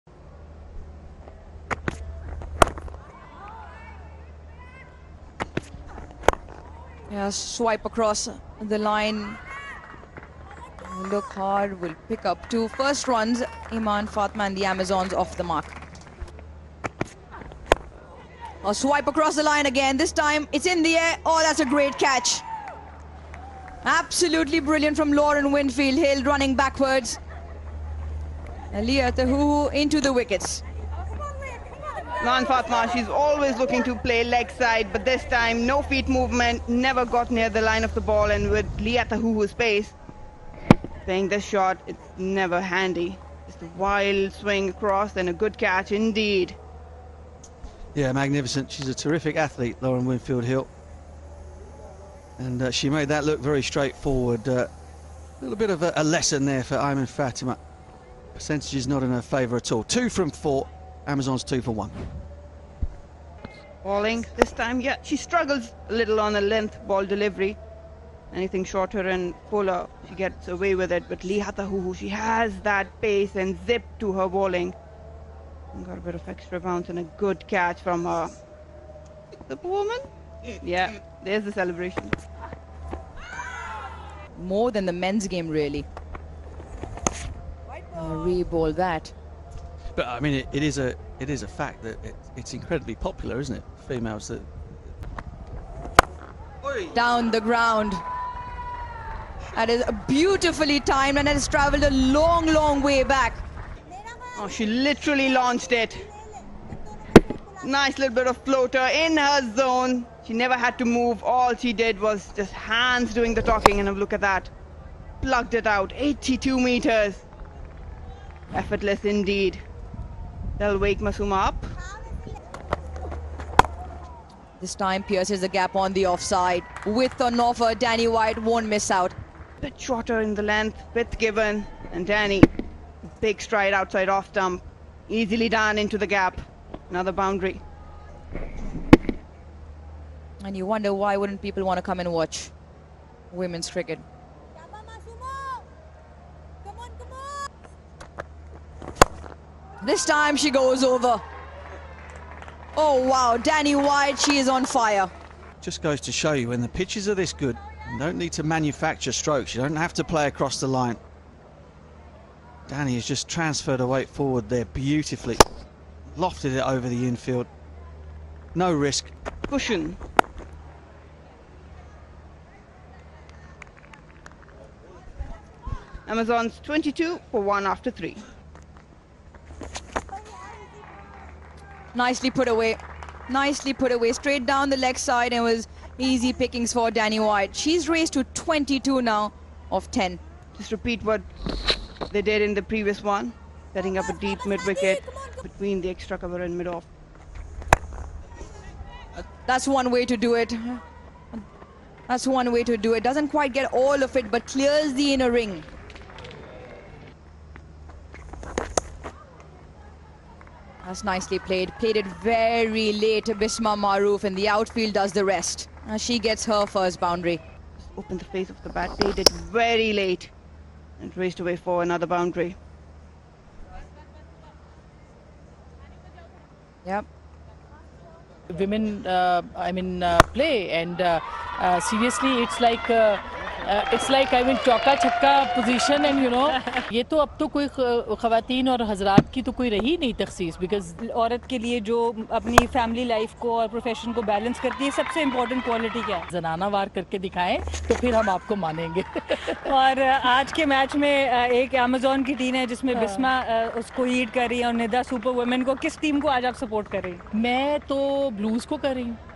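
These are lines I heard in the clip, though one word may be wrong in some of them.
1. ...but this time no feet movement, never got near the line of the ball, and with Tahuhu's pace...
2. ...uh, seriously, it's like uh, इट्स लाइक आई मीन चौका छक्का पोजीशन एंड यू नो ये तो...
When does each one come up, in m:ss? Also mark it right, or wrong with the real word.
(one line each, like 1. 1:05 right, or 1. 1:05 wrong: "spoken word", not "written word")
1. 0:34 right
2. 3:51 right.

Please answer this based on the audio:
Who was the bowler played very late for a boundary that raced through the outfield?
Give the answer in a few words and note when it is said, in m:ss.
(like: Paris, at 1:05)
Bisma Maroof, at 3:33.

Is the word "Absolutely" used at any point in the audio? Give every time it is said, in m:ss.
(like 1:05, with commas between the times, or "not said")
0:23.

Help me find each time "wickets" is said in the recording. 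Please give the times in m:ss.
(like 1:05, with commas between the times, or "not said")
0:30, 3:14.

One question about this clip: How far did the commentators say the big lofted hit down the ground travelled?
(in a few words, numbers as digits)
82 meters.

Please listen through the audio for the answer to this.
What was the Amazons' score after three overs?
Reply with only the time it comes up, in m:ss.
2:56.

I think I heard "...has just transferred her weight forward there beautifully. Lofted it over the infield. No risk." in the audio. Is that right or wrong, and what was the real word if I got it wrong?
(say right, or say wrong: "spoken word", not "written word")
right.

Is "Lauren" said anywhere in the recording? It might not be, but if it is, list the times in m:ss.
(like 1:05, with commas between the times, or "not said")
0:25, 0:49.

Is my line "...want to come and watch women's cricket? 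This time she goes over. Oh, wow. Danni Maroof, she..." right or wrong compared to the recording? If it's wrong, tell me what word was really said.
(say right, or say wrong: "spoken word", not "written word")
wrong: "Wyatt", not "Maroof".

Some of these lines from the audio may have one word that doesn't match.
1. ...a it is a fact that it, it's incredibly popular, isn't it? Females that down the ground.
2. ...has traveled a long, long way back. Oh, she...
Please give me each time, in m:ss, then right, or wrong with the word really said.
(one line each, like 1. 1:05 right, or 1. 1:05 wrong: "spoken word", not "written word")
1. 1:30 right
2. 1:41 right.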